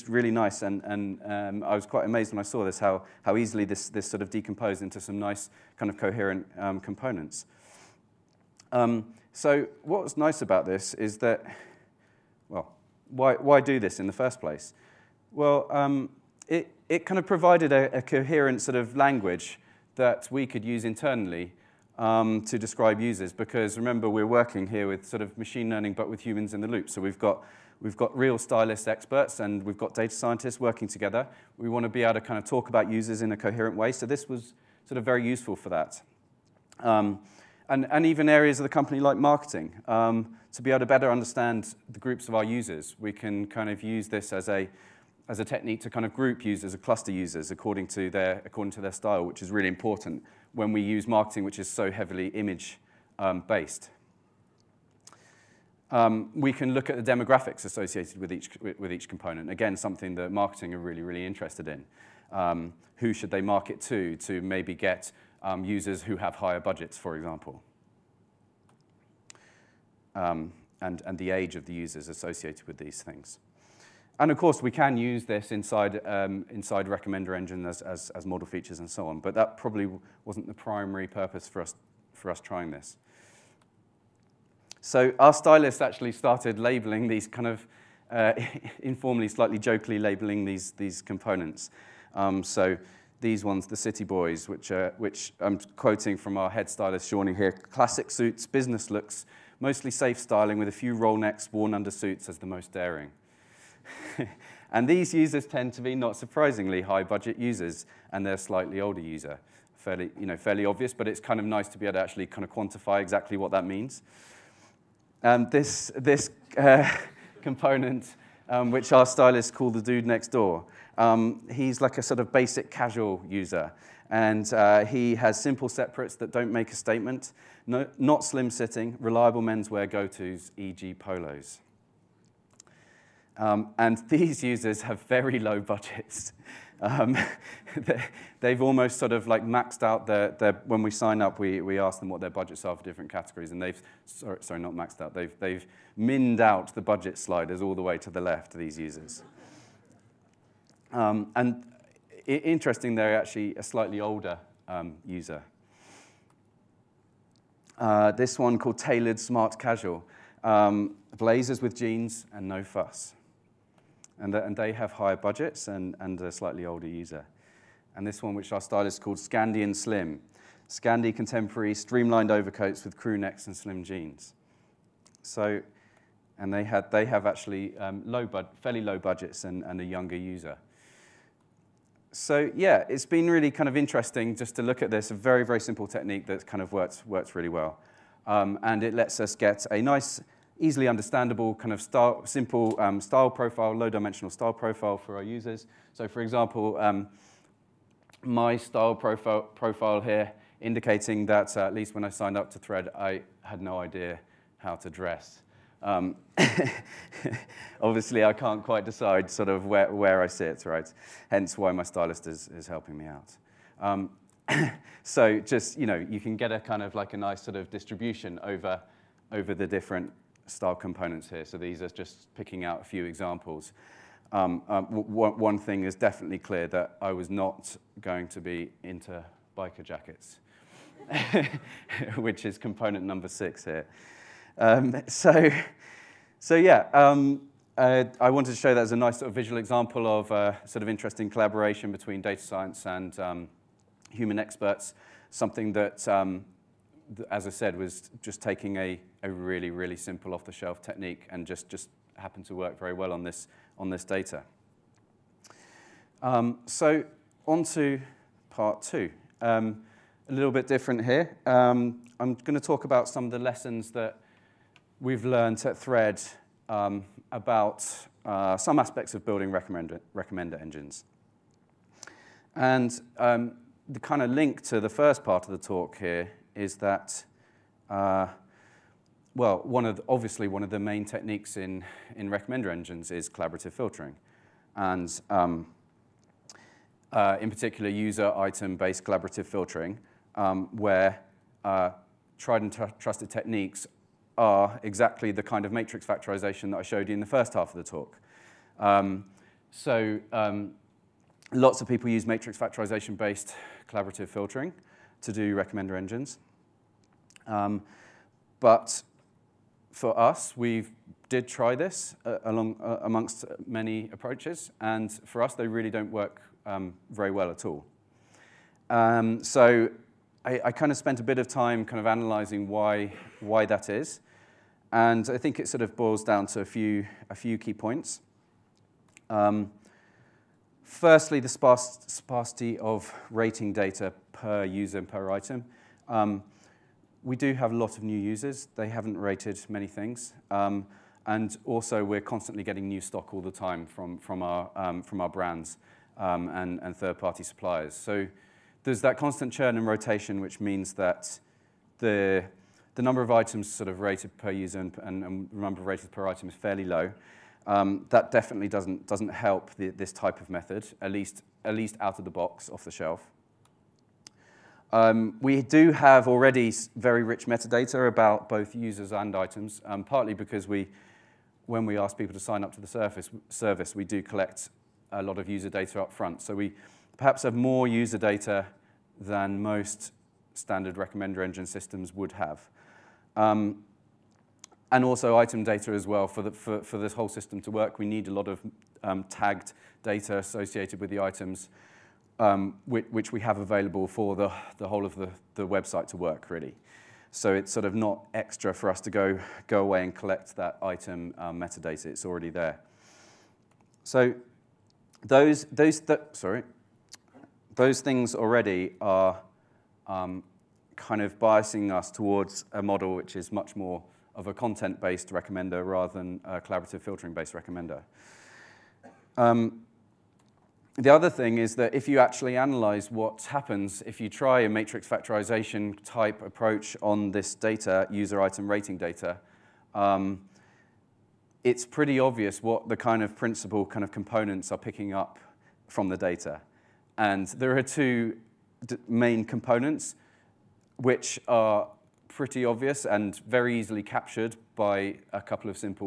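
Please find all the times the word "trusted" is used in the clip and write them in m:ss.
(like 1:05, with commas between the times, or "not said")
4:52.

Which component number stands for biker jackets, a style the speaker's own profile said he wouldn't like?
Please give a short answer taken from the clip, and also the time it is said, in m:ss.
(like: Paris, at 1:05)
6, at 3:53.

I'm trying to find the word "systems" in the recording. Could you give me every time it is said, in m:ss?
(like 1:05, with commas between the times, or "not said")
6:21, 6:27.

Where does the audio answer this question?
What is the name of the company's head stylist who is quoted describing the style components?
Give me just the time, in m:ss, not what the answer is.
1:37.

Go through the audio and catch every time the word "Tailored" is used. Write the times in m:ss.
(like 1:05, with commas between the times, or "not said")
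2:38.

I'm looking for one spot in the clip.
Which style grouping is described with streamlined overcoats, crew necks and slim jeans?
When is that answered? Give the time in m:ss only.
2:49.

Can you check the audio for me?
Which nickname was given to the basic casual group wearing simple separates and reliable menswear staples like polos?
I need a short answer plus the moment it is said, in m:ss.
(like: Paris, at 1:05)
The dude next door, at 1:59.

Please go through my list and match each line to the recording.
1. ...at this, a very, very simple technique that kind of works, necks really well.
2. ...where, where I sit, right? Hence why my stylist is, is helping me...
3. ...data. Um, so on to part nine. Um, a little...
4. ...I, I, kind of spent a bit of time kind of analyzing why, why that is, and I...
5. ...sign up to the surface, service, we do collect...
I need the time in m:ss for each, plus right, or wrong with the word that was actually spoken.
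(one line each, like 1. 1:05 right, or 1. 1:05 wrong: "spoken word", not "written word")
1. 3:04 wrong: "works", not "necks"
2. 3:29 right
3. 4:14 wrong: "two", not "nine"
4. 5:20 right
5. 6:12 right.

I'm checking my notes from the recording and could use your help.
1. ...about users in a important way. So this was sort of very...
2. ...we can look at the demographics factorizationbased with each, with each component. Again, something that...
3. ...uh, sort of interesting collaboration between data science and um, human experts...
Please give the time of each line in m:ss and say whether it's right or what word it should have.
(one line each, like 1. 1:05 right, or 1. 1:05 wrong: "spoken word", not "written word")
1. 0:32 wrong: "coherent", not "important"
2. 0:56 wrong: "associated", not "factorizationbased"
3. 4:00 right.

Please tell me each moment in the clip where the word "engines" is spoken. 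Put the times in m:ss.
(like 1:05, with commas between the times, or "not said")
1:17, 4:30, 4:42, 5:05, 6:21.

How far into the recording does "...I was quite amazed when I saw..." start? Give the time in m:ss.
0:01.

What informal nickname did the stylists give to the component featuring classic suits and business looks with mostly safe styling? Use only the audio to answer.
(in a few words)
The city boys.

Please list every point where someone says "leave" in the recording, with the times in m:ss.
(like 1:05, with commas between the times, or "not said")
not said.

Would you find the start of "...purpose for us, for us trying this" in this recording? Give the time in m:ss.
1:21.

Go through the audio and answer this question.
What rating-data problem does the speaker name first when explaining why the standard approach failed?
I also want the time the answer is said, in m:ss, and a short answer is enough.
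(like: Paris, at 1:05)
Sparsity, at 5:31.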